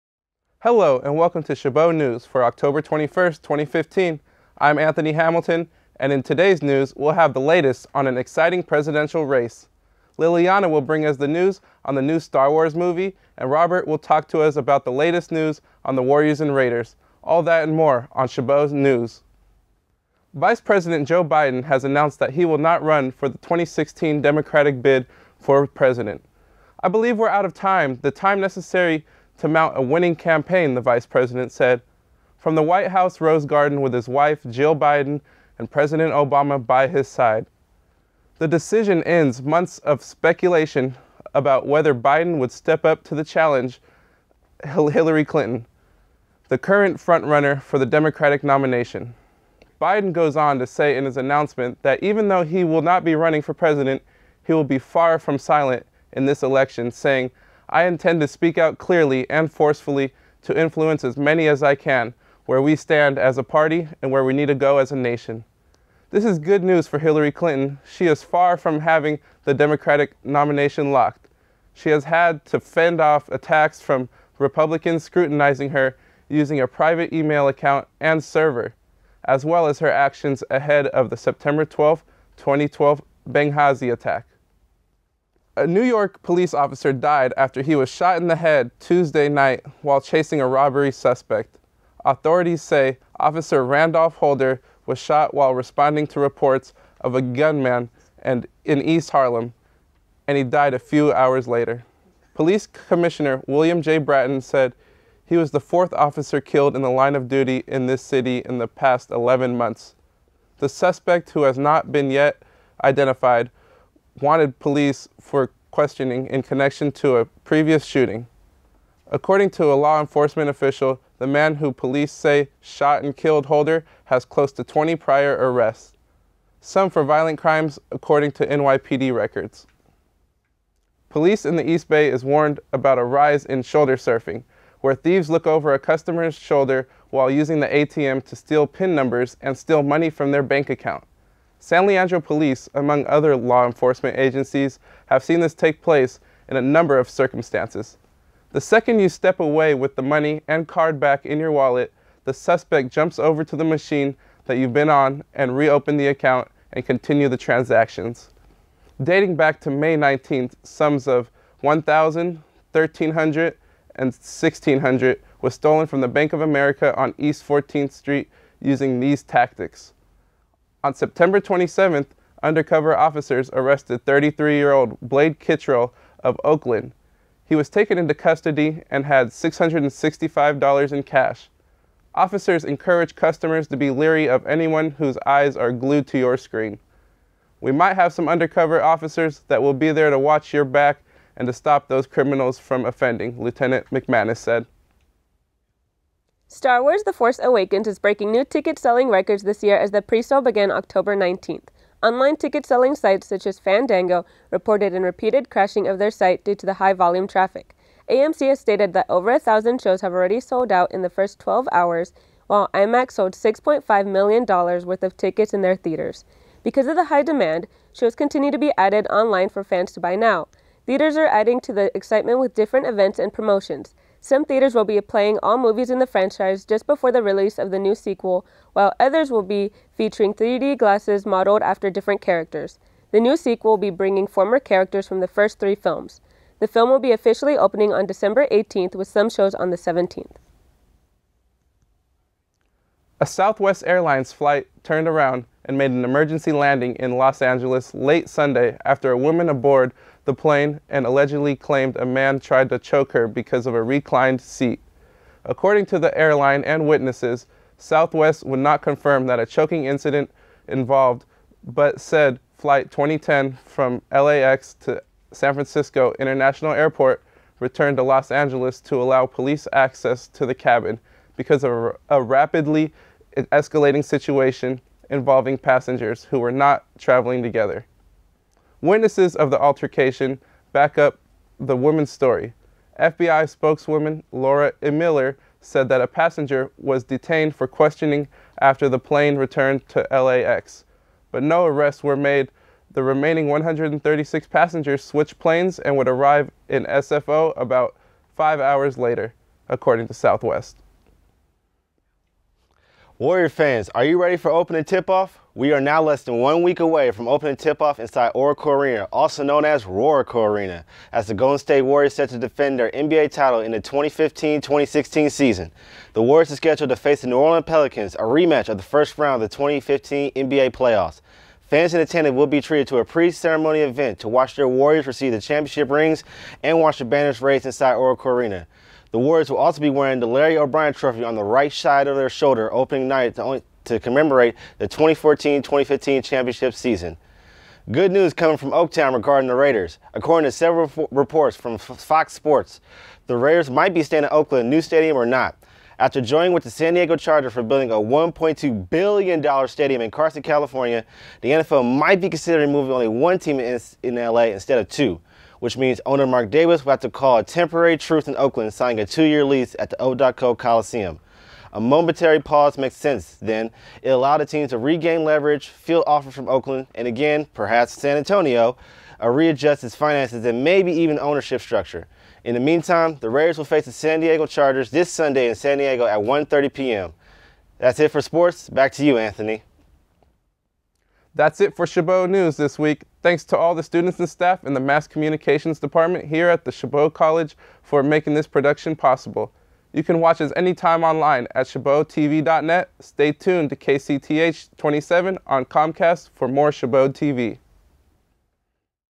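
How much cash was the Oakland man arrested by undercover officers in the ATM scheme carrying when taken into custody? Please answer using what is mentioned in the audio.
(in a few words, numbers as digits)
$665.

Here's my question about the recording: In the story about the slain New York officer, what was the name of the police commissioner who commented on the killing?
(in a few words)
William J. Bratton.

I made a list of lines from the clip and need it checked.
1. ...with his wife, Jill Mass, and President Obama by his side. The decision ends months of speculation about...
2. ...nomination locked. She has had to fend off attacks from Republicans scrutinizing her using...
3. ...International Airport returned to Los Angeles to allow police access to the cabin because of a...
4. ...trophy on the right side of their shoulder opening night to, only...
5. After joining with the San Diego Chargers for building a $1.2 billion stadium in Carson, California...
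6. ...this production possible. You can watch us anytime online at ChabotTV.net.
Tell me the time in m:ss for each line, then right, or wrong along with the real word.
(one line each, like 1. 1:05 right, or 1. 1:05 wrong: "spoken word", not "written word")
1. 0:33 wrong: "Biden", not "Mass"
2. 1:10 right
3. 4:26 right
4. 5:30 right
5. 5:45 right
6. 6:28 right.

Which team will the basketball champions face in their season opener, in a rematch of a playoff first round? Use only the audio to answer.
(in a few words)
New Orleans Pelicans.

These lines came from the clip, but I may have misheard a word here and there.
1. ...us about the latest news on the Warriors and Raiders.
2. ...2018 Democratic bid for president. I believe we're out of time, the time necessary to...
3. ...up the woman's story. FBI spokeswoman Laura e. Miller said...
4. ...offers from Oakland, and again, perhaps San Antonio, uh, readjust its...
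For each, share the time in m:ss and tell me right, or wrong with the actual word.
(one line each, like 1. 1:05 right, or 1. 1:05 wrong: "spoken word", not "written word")
1. 0:14 right
2. 0:23 wrong: "2016", not "2018"
3. 4:40 right
4. 6:06 right.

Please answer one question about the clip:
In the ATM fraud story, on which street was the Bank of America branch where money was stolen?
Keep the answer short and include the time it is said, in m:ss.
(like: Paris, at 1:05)
East 14th Street, at 2:47.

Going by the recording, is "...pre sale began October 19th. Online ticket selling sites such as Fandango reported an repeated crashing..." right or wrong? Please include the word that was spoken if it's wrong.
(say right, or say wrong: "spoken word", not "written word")
right.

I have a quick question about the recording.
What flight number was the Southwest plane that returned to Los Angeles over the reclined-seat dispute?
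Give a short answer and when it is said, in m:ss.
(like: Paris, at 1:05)
2010, at 4:22.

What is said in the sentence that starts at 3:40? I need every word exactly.
Theaters are adding to the excitement with different events and promotions.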